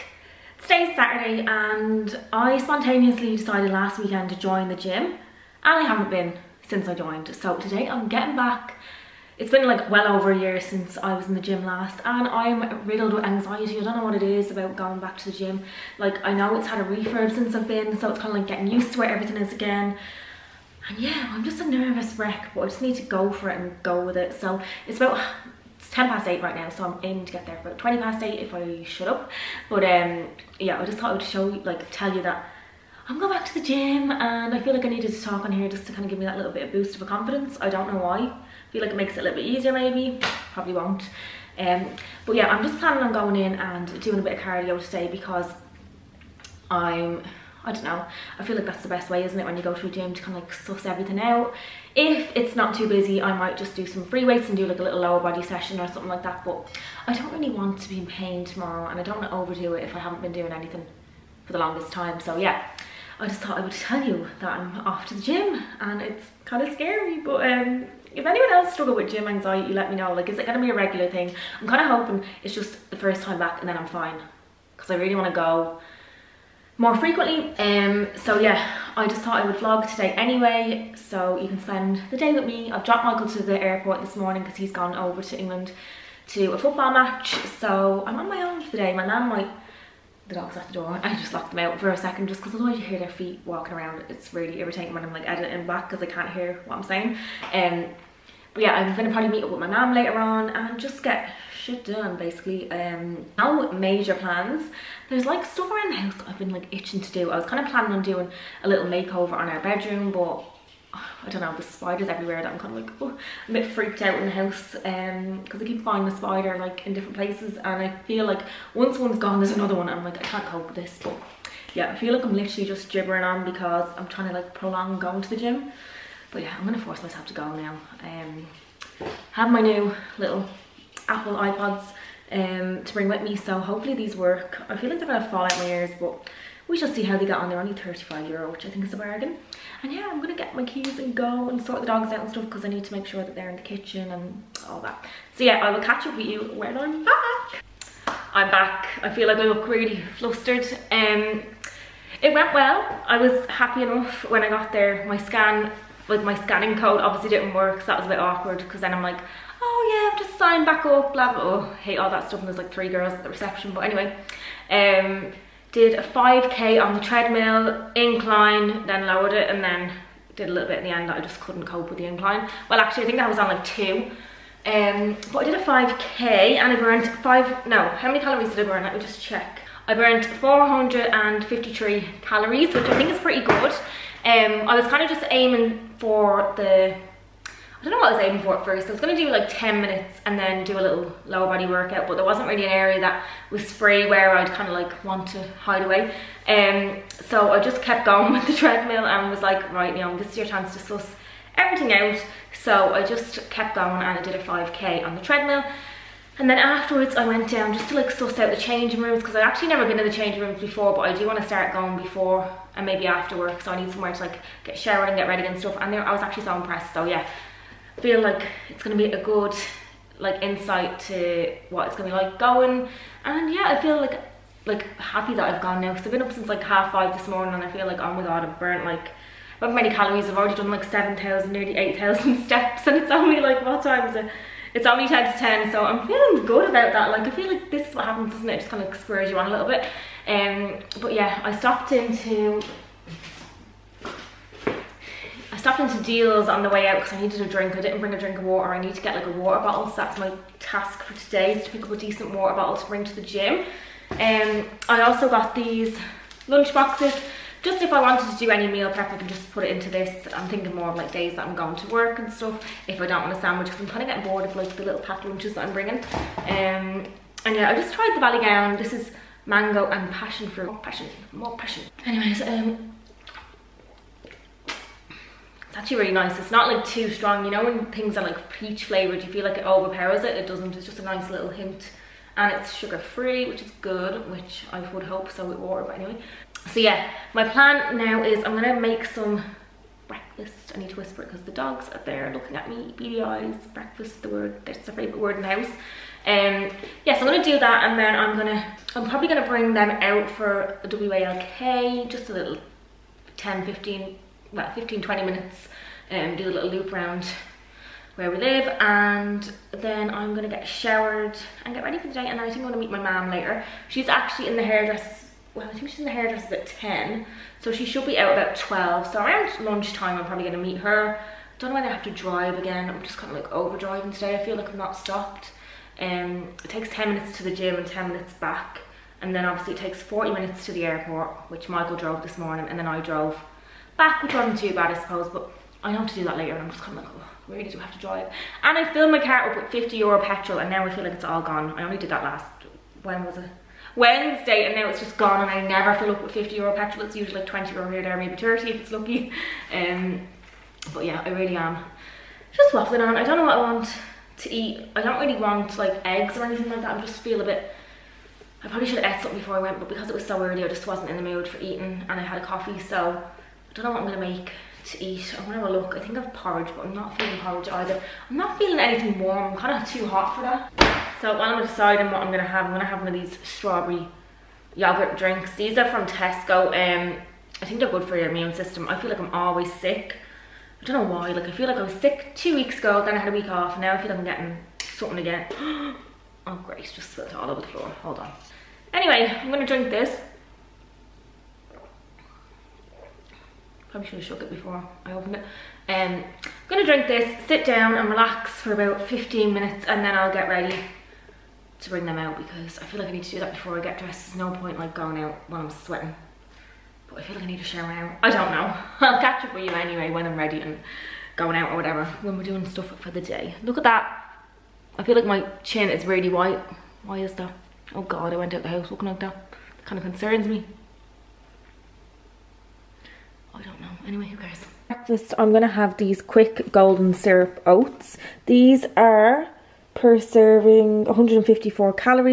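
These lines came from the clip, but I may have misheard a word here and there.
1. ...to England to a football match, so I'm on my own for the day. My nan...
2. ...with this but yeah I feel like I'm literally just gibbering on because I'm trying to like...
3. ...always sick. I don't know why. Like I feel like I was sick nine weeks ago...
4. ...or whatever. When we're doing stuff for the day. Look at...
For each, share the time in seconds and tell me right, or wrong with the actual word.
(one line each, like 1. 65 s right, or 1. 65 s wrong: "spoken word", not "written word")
1. 85 s right
2. 120 s right
3. 379 s wrong: "two", not "nine"
4. 411 s right.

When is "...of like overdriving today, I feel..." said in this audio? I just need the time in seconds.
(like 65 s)
323 s.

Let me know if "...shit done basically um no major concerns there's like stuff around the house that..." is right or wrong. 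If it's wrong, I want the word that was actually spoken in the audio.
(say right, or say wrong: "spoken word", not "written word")
wrong: "plans", not "concerns".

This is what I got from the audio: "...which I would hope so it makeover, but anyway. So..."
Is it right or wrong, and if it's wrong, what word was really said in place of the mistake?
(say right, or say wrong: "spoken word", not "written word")
wrong: "water", not "makeover".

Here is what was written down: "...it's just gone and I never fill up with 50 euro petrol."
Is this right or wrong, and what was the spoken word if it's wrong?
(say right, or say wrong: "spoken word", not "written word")
right.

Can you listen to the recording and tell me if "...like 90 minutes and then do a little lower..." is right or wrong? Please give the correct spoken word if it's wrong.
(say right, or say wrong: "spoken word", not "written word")
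wrong: "10", not "90".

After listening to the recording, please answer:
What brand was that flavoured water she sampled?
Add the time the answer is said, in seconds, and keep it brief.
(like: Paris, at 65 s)
Ballygowan, at 268 s.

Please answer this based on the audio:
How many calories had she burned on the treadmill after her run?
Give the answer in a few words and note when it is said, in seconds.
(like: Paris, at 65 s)
453, at 180 s.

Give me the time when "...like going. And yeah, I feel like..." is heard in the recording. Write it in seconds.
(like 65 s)
222 s.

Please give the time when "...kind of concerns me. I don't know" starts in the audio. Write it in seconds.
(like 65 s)
419 s.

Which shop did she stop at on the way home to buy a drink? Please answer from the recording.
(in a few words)
Dealz.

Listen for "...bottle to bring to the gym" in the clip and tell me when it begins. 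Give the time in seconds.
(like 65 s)
252 s.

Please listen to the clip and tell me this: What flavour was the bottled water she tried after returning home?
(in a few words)
Mango and passion fruit.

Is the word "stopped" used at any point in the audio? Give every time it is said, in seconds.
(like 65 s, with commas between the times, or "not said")
241 s, 245 s, 324 s.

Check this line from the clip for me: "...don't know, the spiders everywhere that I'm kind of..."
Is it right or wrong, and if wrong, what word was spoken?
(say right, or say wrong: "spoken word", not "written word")
right.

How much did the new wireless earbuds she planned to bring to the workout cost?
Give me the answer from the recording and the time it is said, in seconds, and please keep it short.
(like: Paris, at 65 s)
35 euro, at 137 s.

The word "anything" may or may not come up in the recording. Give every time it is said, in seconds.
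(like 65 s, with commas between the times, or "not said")
60 s, 356 s, 368 s.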